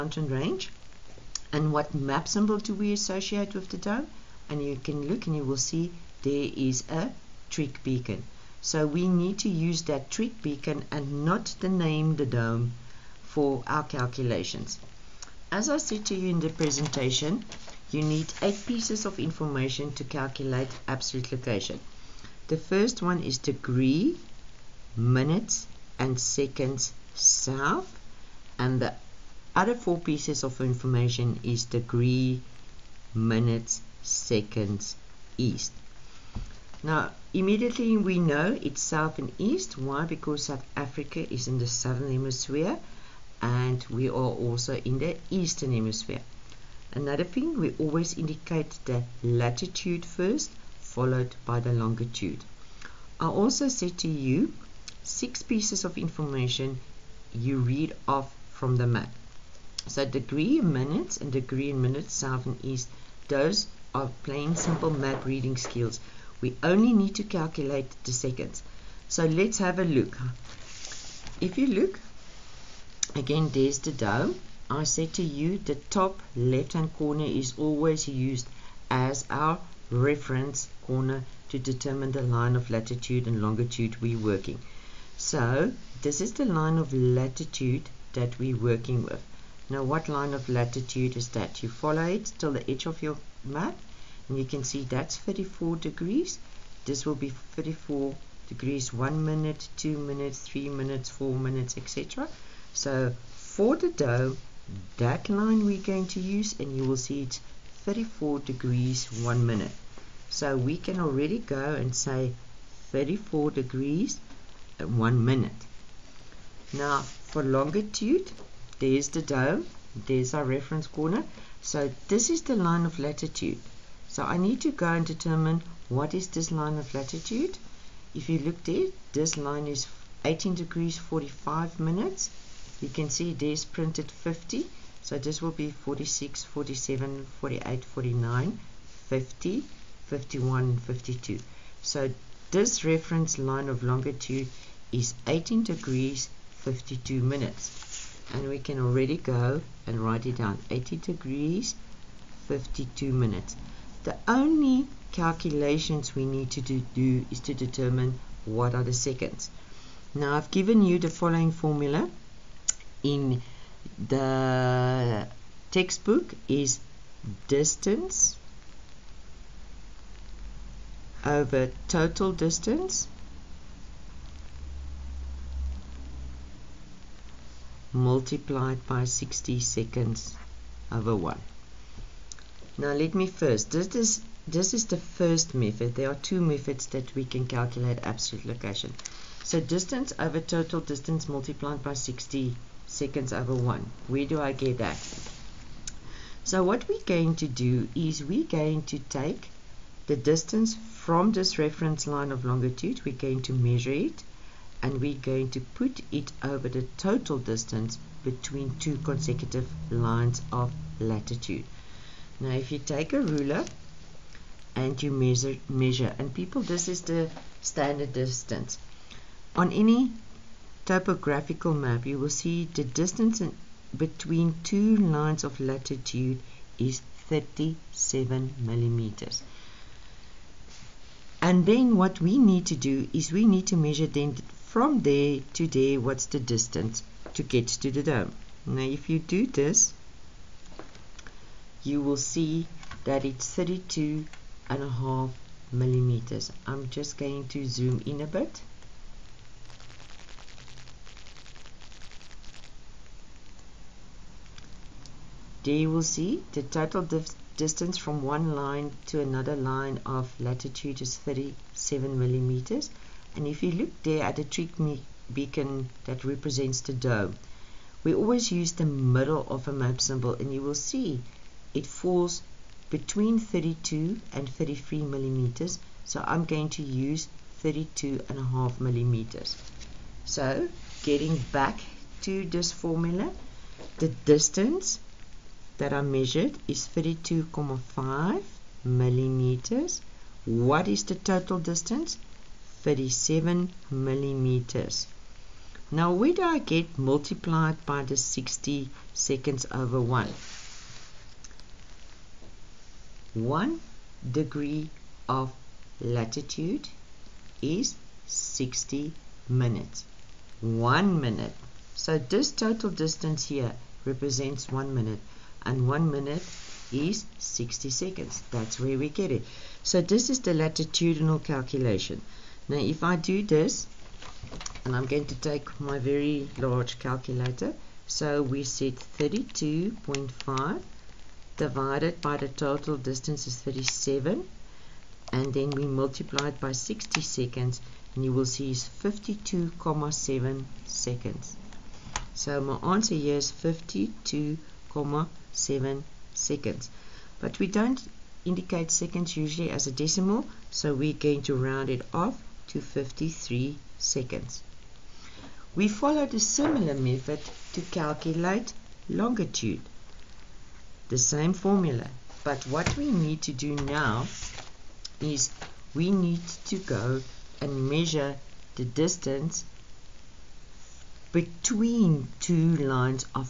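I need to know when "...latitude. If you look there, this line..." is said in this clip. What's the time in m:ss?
2:06.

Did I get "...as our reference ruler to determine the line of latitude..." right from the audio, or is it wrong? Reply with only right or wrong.
wrong.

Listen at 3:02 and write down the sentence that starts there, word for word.
Now let me first, this is, this is the first method.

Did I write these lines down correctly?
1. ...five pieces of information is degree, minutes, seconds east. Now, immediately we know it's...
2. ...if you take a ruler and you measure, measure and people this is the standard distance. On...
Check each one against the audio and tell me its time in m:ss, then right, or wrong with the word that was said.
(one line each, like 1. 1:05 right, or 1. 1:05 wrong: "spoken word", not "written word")
1. 0:29 wrong: "four", not "five"
2. 3:32 right.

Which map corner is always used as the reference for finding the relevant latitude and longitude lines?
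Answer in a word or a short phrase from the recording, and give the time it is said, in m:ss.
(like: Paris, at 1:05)
Top left hand corner, at 1:15.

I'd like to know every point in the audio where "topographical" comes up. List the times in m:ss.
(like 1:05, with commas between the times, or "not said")
3:40.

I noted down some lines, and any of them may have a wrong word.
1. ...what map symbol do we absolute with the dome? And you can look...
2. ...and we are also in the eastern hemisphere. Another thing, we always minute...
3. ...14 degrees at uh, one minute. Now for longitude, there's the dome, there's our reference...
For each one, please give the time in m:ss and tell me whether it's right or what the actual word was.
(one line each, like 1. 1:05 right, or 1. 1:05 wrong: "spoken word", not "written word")
1. 0:01 wrong: "associate", not "absolute"
2. 0:43 wrong: "indicate", not "minute"
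3. 1:52 wrong: "34", not "14".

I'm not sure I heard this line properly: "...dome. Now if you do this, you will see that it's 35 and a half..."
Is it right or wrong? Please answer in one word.
wrong.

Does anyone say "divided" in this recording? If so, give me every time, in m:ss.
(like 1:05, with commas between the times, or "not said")
5:31.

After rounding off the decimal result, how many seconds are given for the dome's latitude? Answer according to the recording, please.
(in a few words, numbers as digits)
53 seconds.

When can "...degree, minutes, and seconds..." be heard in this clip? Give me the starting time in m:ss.
0:23.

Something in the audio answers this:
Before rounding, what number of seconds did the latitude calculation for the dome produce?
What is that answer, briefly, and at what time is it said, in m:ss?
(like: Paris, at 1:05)
52.7 seconds, at 5:38.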